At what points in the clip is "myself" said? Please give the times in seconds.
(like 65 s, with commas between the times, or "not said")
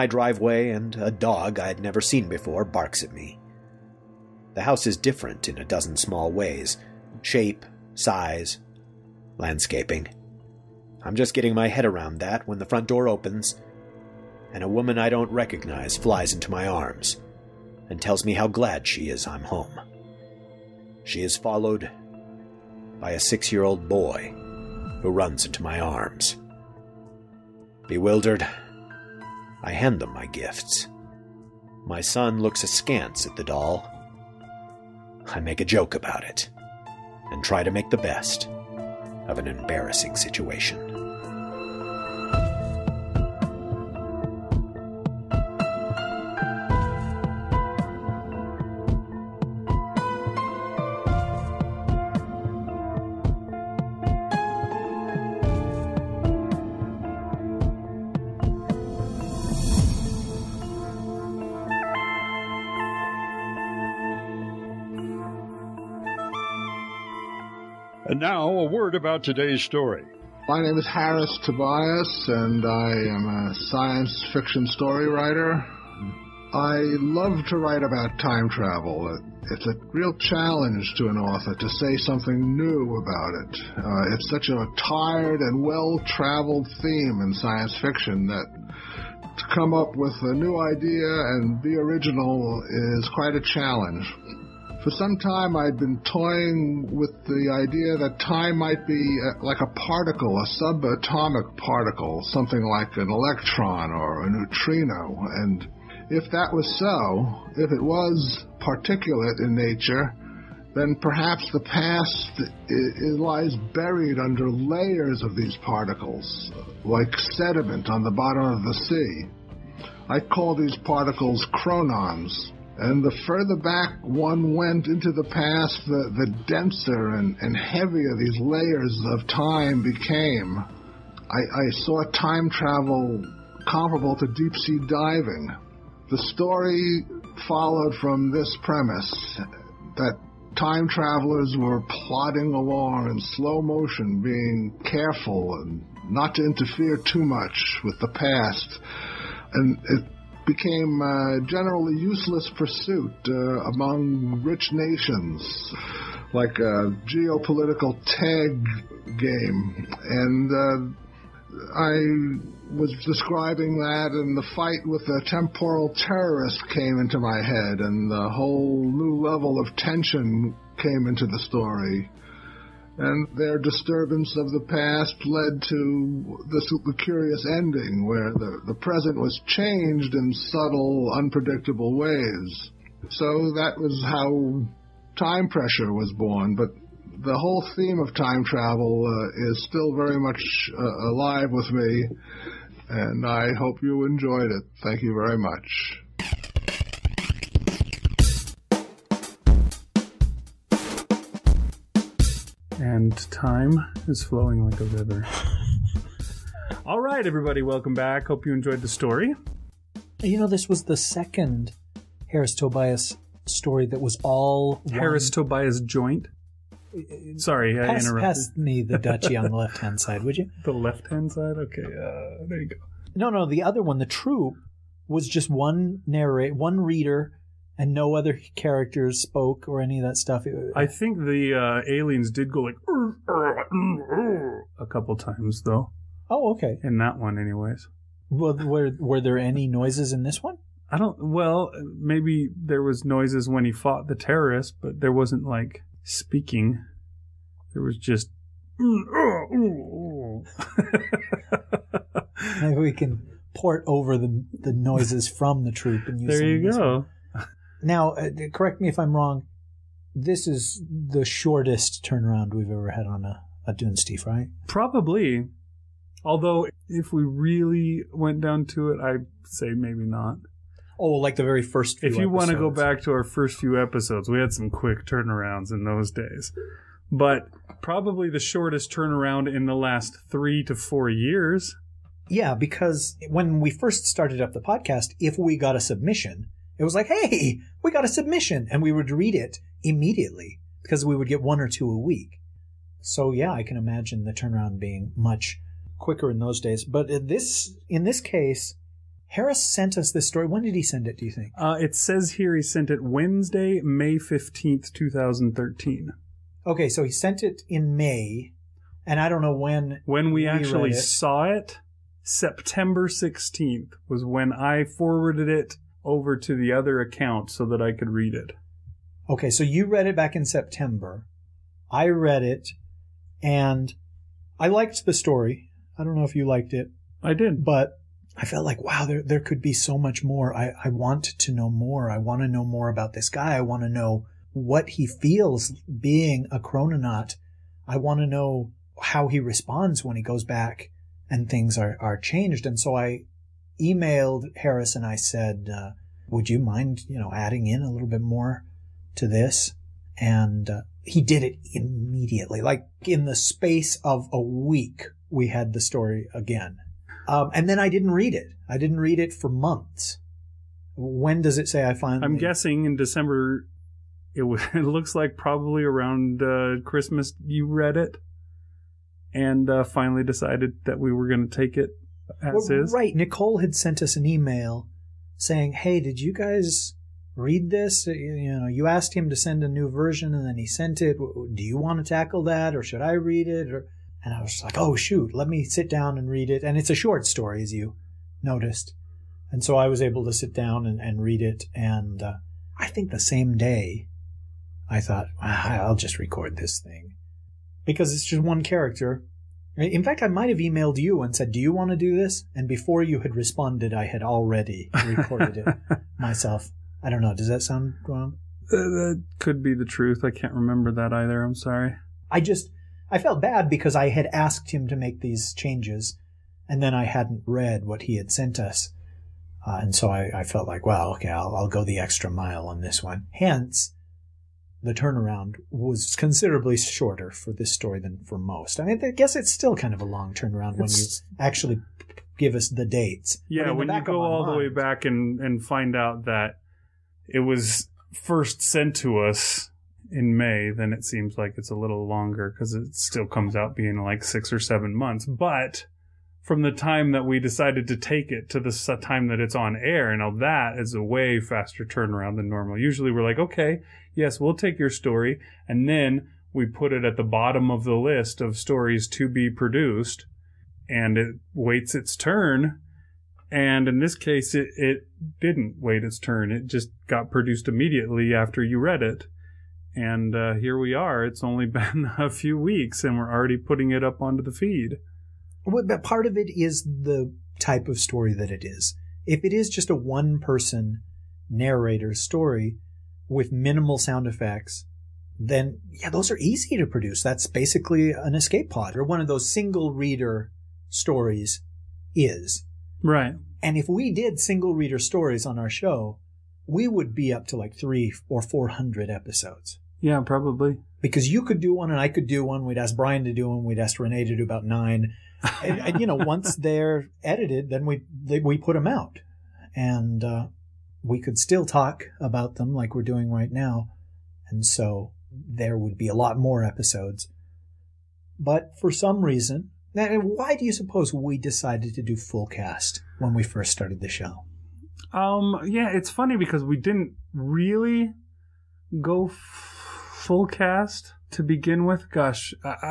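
406 s.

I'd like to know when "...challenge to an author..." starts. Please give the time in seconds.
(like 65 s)
80 s.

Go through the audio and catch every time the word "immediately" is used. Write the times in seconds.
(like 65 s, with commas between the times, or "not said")
289 s, 351 s, 467 s.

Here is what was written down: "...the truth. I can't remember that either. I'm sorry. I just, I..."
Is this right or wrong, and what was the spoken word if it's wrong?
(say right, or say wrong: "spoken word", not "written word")
right.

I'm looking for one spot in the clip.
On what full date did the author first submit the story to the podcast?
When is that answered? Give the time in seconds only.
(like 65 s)
303 s.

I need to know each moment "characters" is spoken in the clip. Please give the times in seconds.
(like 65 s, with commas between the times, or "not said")
228 s, 398 s.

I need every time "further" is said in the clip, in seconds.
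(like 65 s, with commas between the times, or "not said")
123 s.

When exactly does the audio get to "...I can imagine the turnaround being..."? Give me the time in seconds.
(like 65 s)
293 s.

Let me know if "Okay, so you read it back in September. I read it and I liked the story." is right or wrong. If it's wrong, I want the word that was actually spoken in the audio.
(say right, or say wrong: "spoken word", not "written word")
right.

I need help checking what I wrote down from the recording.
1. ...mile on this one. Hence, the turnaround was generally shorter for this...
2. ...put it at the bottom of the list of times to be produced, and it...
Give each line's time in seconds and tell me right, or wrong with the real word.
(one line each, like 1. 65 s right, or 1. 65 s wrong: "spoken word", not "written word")
1. 422 s wrong: "considerably", not "generally"
2. 456 s wrong: "stories", not "times".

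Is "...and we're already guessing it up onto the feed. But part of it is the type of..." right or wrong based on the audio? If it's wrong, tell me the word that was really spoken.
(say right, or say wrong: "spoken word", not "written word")
wrong: "putting", not "guessing".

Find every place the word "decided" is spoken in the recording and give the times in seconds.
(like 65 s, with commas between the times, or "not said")
370 s, 447 s, 521 s.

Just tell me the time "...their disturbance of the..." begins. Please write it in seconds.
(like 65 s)
173 s.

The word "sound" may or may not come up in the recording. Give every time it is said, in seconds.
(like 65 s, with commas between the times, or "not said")
407 s, 483 s.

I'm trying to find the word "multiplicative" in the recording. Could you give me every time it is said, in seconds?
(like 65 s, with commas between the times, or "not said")
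not said.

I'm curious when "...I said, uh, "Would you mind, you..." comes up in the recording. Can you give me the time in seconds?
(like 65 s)
345 s.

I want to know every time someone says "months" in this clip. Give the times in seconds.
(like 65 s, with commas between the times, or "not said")
359 s, 444 s.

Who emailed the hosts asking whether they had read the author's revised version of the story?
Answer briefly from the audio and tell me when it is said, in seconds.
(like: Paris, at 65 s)
Nicole, at 373 s.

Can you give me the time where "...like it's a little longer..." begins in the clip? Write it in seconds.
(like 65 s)
441 s.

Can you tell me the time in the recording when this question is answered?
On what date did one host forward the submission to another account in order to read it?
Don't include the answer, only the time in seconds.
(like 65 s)
312 s.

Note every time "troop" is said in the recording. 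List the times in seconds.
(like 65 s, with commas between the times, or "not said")
224 s, 255 s.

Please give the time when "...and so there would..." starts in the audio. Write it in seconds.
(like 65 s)
514 s.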